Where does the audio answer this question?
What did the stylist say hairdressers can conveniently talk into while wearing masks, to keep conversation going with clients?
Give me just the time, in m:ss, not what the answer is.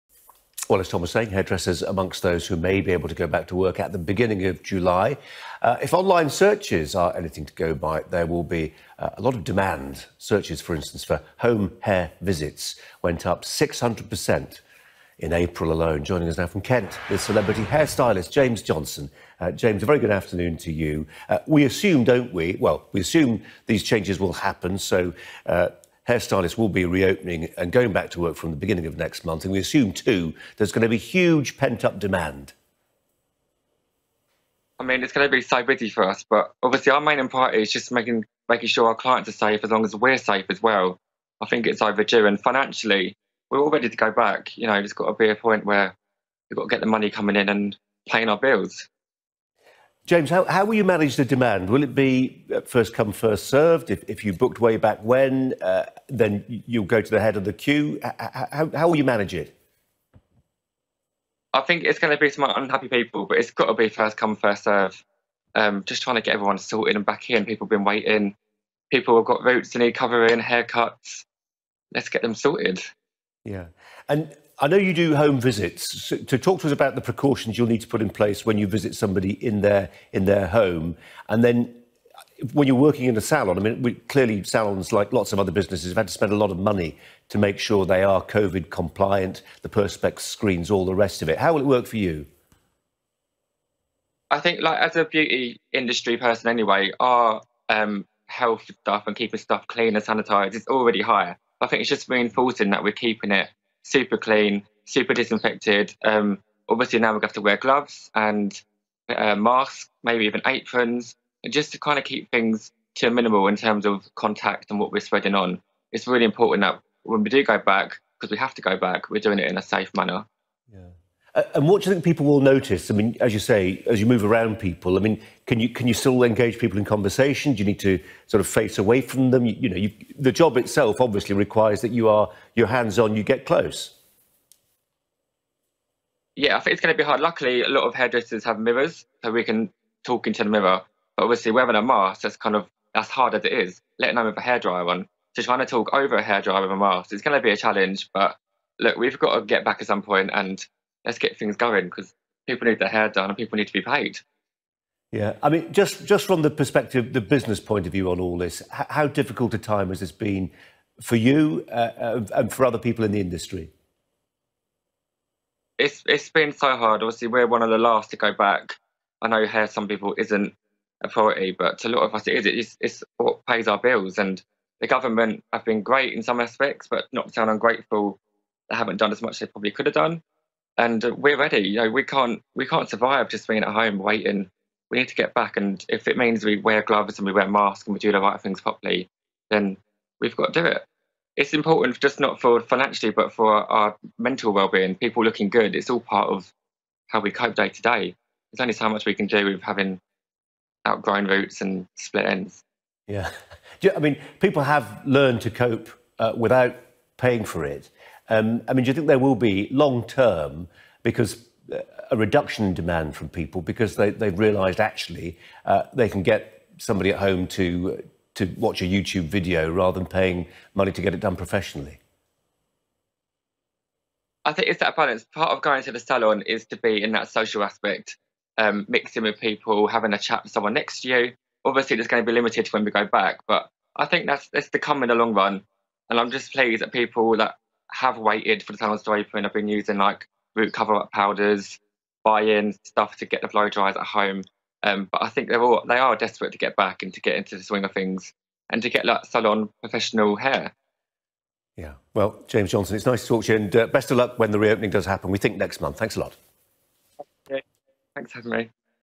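2:18.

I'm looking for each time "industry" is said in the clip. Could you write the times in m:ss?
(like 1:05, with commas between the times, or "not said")
1:35, 2:43.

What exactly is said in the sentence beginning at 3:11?
It's important just not for financially, but for our mental well-being.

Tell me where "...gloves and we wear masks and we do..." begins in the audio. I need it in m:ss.
3:06.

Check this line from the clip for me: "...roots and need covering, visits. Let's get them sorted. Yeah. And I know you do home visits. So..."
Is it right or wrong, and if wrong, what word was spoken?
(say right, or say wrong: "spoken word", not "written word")
wrong: "haircuts", not "visits".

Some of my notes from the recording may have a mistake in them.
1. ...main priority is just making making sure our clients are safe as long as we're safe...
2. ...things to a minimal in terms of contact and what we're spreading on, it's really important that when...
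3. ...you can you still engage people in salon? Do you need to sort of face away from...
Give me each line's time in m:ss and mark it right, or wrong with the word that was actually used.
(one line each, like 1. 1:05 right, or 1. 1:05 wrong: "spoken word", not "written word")
1. 0:37 right
2. 1:52 right
3. 2:05 wrong: "conversation", not "salon".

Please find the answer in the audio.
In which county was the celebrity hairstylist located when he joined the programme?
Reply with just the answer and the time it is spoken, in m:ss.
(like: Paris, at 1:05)
Kent, at 0:16.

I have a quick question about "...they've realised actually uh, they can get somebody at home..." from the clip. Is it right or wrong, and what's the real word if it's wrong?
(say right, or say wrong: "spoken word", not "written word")
right.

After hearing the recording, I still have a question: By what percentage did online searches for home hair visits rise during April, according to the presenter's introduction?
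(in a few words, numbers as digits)
600%.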